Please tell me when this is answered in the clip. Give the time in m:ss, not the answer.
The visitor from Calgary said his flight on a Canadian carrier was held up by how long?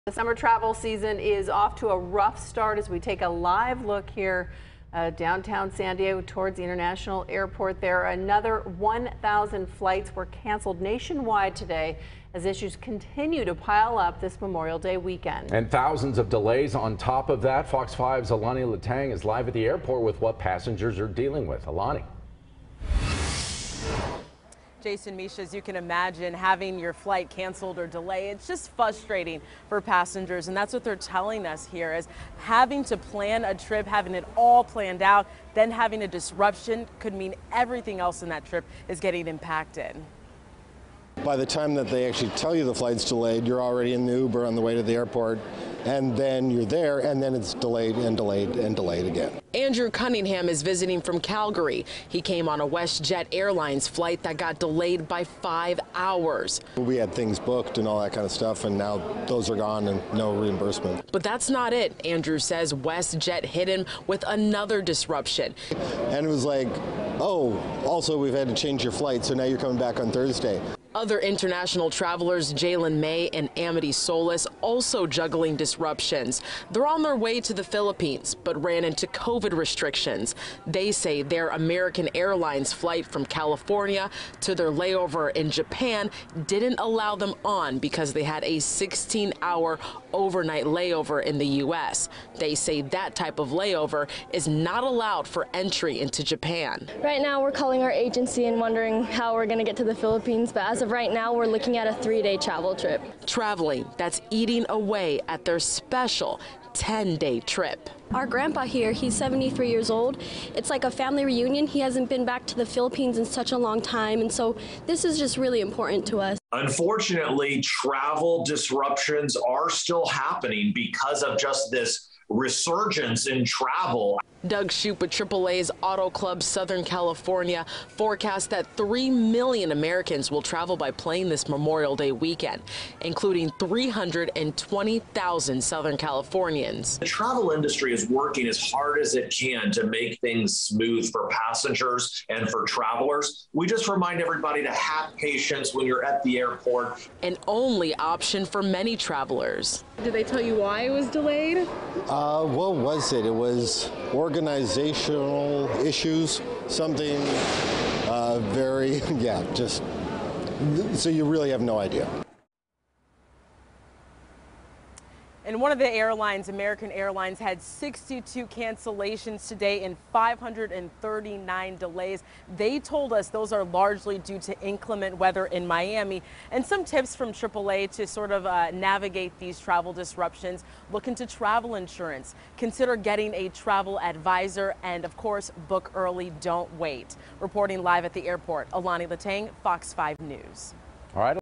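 0:55.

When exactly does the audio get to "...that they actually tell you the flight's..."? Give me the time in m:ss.
0:41.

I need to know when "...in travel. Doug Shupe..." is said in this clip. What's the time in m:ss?
2:03.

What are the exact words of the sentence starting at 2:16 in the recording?
The travel industry is working as hard as it can to make things smooth for passengers and for travelers.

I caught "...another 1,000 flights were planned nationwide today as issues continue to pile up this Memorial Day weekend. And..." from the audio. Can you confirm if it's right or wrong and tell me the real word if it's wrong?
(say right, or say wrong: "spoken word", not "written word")
wrong: "canceled", not "planned".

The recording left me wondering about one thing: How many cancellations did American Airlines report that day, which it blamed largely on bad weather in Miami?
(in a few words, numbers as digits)
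62.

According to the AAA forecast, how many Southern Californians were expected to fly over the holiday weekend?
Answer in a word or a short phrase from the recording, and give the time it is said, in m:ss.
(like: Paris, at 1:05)
320,000, at 2:13.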